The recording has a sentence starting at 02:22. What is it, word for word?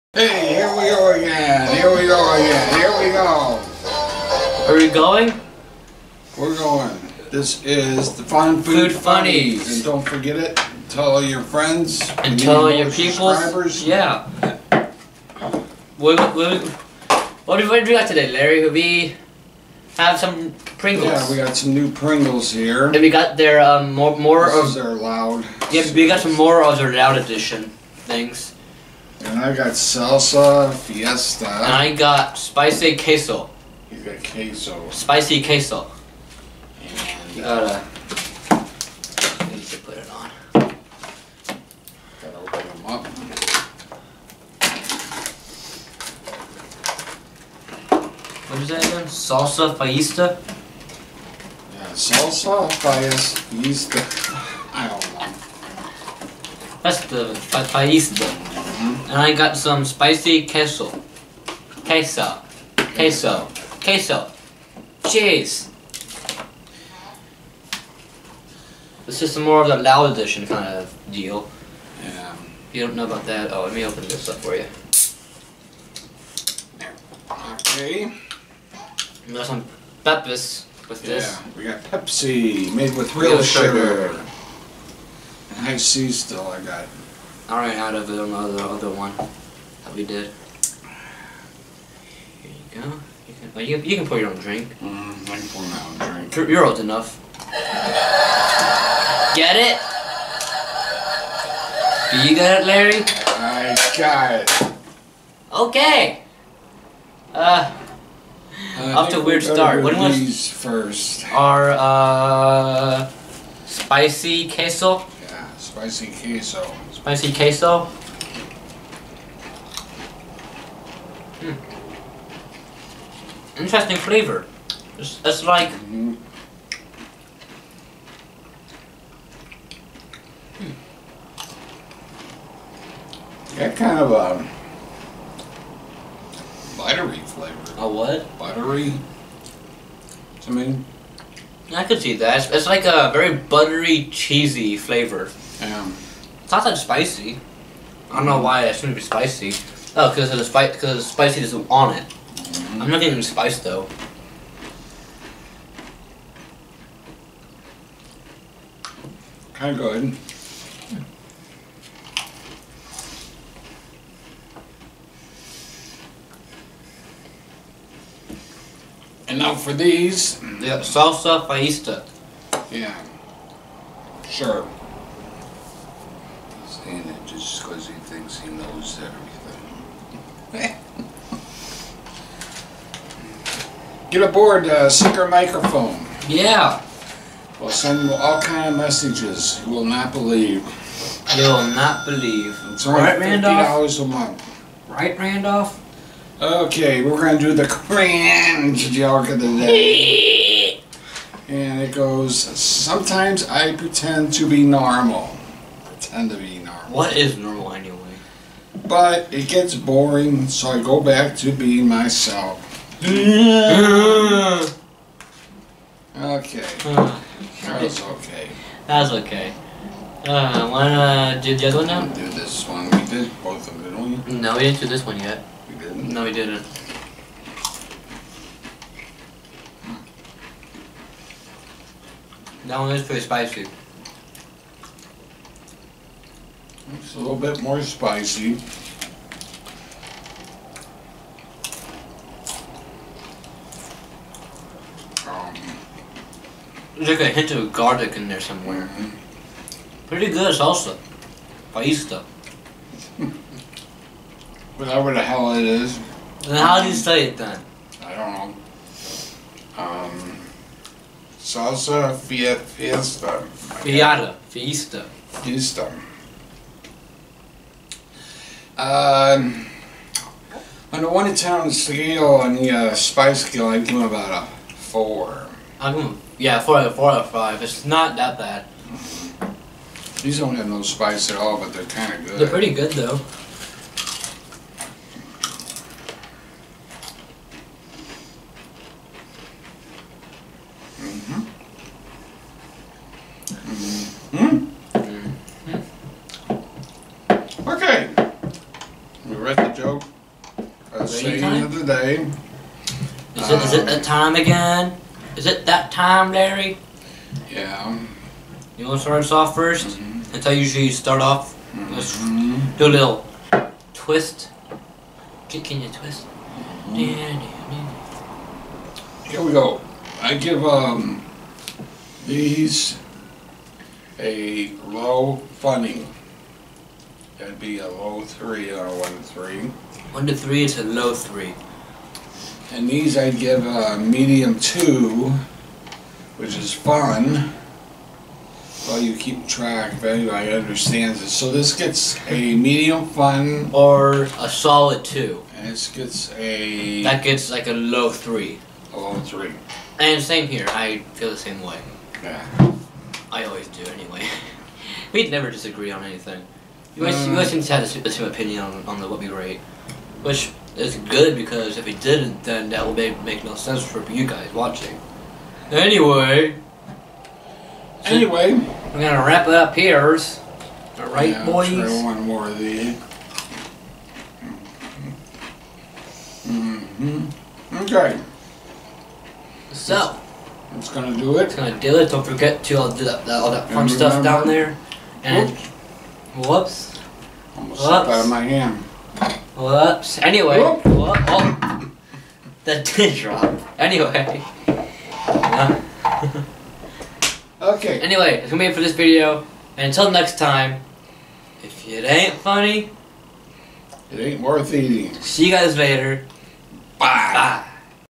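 it's like a very buttery, cheesy flavor.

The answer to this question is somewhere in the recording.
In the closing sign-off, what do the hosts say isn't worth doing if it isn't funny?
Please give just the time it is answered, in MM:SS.
06:44.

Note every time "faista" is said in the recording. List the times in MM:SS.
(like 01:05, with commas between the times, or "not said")
02:51.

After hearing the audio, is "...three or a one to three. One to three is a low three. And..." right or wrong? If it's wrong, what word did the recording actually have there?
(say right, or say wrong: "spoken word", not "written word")
right.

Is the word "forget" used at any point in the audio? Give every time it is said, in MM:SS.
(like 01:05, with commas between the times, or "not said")
00:10, 06:22.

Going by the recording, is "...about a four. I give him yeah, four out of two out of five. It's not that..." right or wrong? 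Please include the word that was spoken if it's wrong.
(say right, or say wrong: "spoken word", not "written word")
wrong: "four", not "two".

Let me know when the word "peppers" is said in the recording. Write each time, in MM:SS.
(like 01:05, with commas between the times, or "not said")
01:20.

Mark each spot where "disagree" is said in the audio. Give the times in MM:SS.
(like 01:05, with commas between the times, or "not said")
05:55.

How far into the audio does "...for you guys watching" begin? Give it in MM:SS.
06:03.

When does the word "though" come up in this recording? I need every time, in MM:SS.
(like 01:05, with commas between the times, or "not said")
02:33, 04:42.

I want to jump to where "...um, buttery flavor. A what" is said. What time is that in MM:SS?
02:14.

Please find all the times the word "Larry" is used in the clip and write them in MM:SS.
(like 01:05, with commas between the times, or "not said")
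00:18, 01:42, 05:06.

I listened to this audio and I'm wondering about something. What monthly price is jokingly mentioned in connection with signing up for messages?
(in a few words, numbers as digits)
$50.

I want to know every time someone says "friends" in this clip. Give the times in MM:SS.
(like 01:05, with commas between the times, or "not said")
00:11.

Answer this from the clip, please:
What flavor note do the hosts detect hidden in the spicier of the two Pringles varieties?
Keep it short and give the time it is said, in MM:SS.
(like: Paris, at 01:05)
Garlic, at 04:07.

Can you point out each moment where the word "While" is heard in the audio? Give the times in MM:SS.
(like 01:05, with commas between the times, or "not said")
05:38.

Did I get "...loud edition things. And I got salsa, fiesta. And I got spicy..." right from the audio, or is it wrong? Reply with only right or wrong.
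right.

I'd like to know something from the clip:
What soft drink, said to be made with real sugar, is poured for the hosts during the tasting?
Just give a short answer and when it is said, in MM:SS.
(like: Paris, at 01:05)
Pepsi, at 01:21.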